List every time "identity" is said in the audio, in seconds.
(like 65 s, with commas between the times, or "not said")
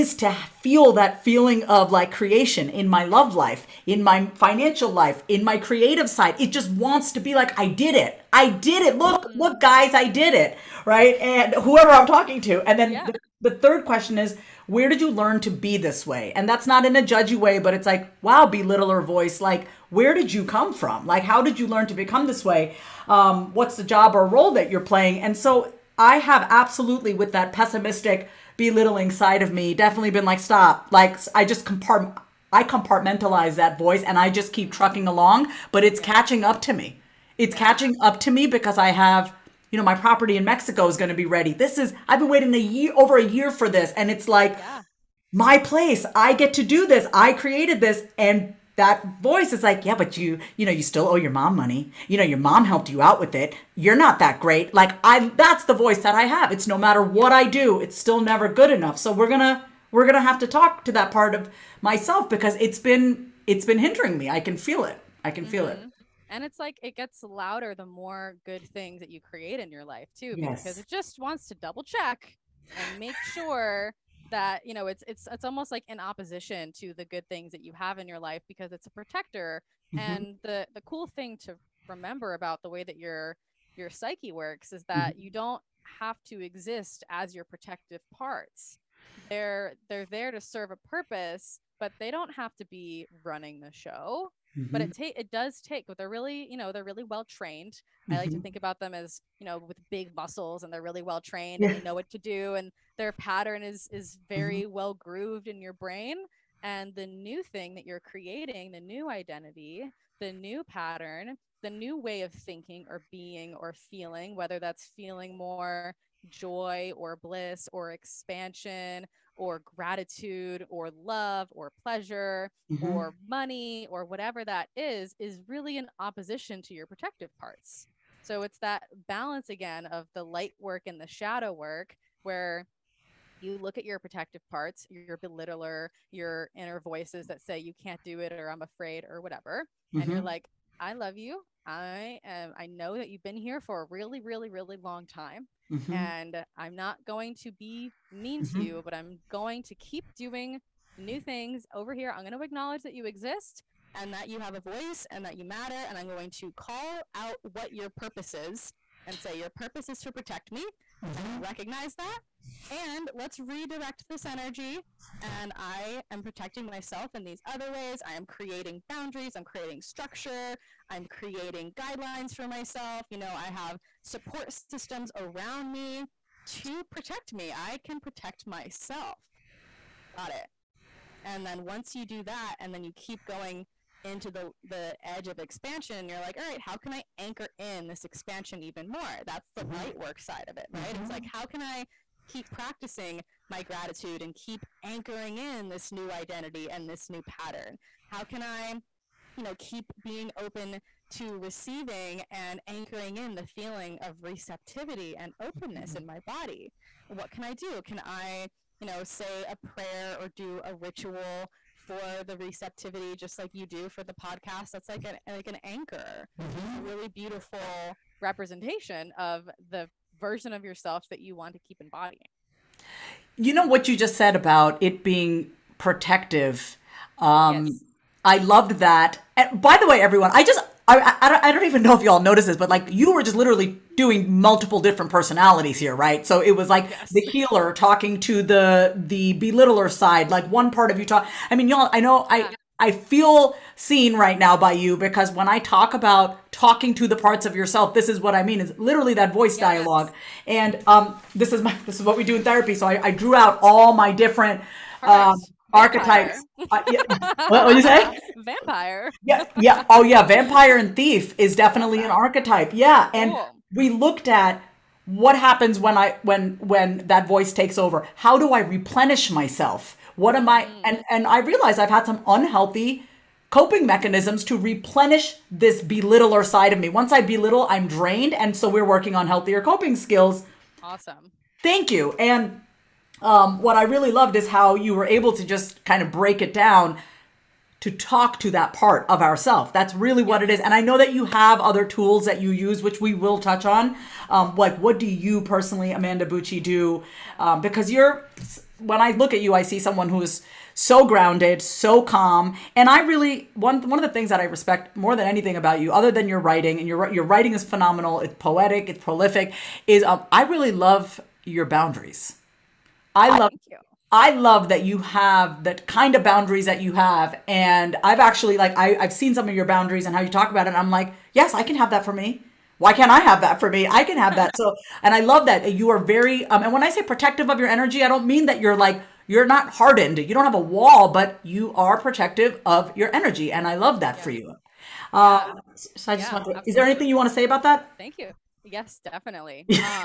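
109 s, 196 s.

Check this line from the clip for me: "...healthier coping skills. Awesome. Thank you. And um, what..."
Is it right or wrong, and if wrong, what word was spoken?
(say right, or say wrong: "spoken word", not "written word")
right.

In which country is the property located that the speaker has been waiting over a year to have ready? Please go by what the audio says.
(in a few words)
Mexico.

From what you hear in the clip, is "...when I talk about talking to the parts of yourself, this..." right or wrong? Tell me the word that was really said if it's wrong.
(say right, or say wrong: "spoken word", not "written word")
right.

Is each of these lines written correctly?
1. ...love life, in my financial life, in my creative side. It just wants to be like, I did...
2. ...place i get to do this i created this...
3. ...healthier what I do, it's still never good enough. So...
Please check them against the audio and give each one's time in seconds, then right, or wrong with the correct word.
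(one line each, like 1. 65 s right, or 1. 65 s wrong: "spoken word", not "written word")
1. 3 s right
2. 45 s right
3. 56 s wrong: "matter", not "healthier".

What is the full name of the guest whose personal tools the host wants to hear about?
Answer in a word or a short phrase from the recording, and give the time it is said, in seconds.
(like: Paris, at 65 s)
Amanda Bucci, at 295 s.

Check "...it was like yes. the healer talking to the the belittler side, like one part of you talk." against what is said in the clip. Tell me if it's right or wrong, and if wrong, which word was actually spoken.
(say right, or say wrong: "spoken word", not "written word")
right.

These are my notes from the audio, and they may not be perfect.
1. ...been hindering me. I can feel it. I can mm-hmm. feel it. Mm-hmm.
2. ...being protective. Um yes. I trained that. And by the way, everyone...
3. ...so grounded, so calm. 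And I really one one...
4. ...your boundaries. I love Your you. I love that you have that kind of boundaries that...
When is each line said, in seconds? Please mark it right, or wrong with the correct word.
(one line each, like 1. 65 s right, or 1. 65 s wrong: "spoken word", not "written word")
1. 63 s right
2. 225 s wrong: "loved", not "trained"
3. 300 s right
4. 311 s wrong: "Thank", not "Your".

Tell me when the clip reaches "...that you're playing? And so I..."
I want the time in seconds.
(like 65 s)
24 s.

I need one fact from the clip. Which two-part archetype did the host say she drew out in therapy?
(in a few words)
Vampire and thief.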